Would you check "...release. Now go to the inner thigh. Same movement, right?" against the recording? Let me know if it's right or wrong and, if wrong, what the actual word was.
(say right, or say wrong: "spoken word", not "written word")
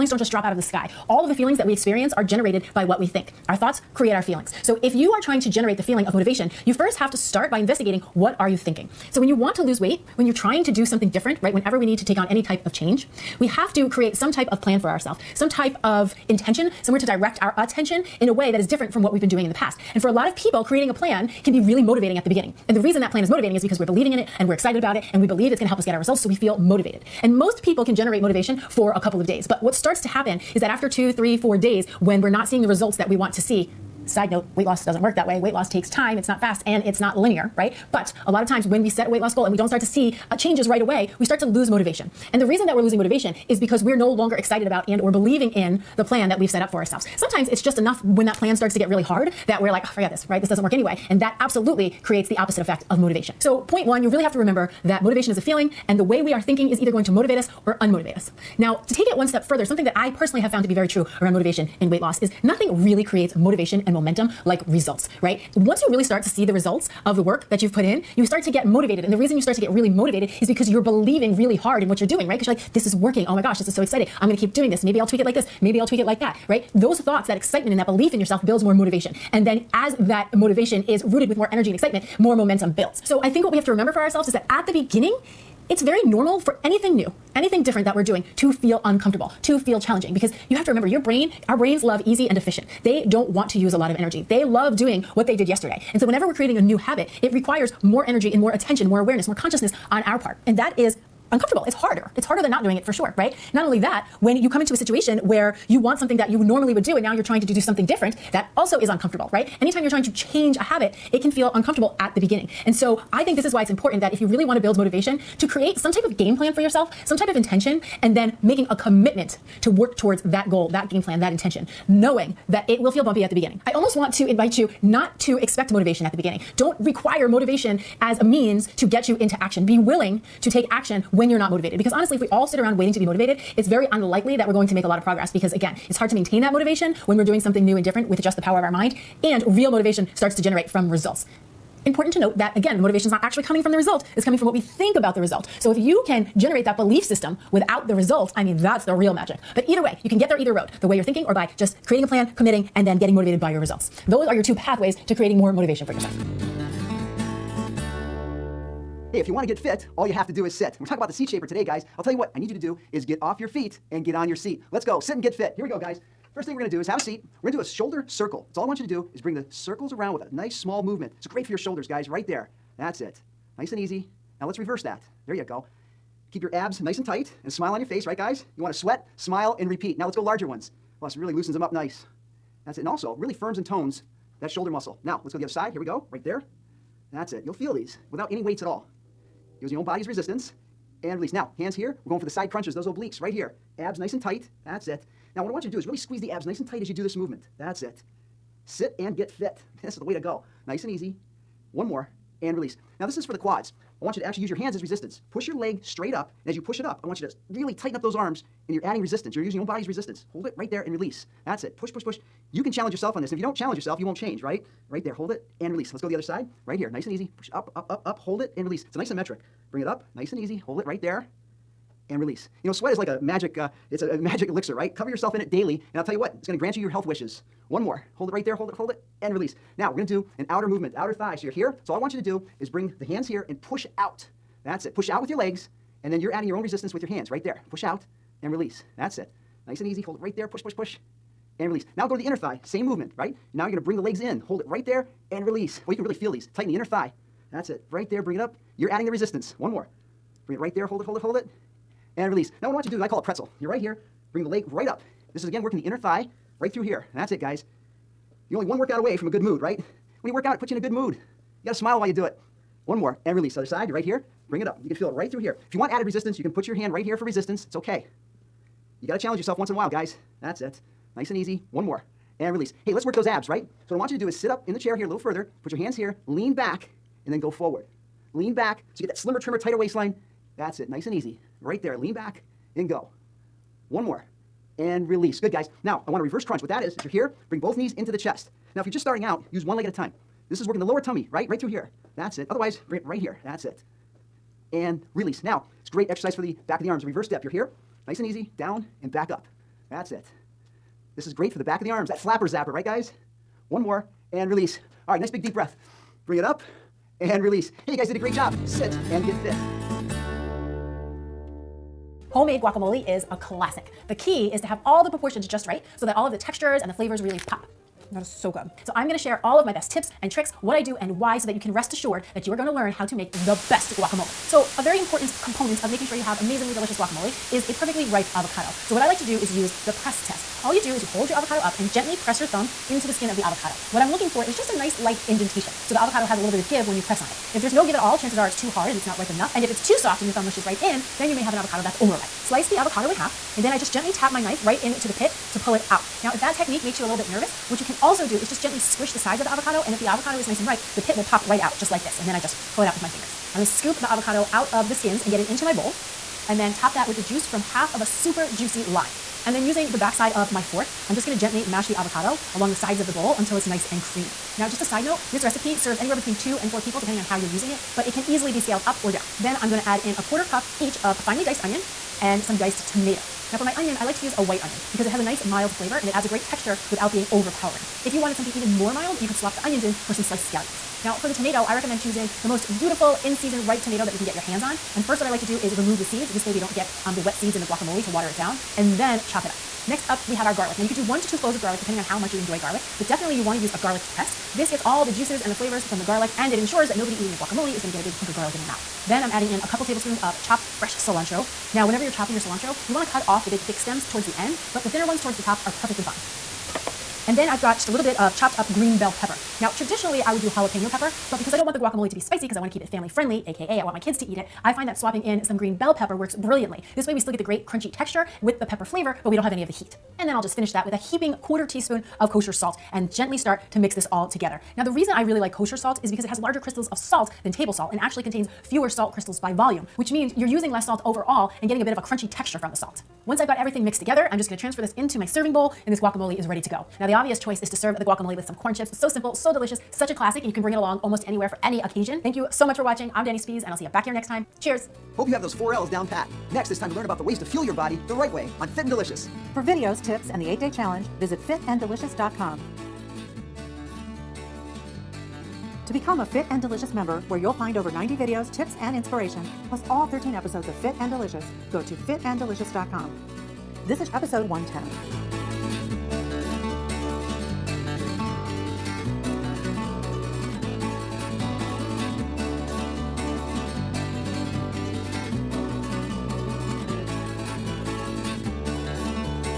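right.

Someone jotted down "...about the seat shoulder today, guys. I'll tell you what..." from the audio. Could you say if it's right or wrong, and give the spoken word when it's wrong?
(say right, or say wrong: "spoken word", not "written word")
wrong: "shaper", not "shoulder".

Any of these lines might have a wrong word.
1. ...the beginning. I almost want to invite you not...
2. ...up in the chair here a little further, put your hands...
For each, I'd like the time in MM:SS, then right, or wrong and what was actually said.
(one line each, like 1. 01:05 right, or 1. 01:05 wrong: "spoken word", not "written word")
1. 02:03 right
2. 04:34 right.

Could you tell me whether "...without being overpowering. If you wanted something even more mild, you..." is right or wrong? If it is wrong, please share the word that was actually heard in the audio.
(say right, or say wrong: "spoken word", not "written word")
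right.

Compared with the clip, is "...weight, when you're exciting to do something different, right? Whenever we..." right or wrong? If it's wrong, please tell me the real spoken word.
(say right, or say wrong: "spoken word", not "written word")
wrong: "trying", not "exciting".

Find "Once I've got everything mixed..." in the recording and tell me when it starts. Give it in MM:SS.
07:13.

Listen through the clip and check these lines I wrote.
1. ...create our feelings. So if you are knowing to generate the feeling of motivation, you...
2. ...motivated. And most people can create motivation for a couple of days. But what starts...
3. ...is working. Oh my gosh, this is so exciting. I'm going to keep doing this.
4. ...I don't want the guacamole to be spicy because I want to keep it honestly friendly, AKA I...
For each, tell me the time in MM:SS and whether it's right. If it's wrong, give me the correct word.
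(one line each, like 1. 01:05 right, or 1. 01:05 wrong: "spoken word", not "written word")
1. 00:03 wrong: "trying", not "knowing"
2. 00:26 wrong: "generate", not "create"
3. 01:12 right
4. 06:51 wrong: "family", not "honestly".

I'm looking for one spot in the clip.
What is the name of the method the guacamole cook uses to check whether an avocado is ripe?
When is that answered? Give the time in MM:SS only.
05:29.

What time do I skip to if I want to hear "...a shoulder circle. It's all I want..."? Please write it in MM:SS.
02:47.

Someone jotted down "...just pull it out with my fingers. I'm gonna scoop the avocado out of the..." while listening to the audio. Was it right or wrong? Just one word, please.
right.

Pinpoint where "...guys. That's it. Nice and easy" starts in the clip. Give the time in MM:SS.
04:29.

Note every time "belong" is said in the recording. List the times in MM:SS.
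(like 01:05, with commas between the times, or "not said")
not said.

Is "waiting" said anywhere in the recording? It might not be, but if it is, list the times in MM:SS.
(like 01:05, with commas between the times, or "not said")
02:12.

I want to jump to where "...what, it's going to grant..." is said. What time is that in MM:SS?
03:46.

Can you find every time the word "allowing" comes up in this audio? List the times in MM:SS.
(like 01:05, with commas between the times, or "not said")
not said.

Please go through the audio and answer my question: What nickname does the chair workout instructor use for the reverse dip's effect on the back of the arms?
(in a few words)
flapper zapper.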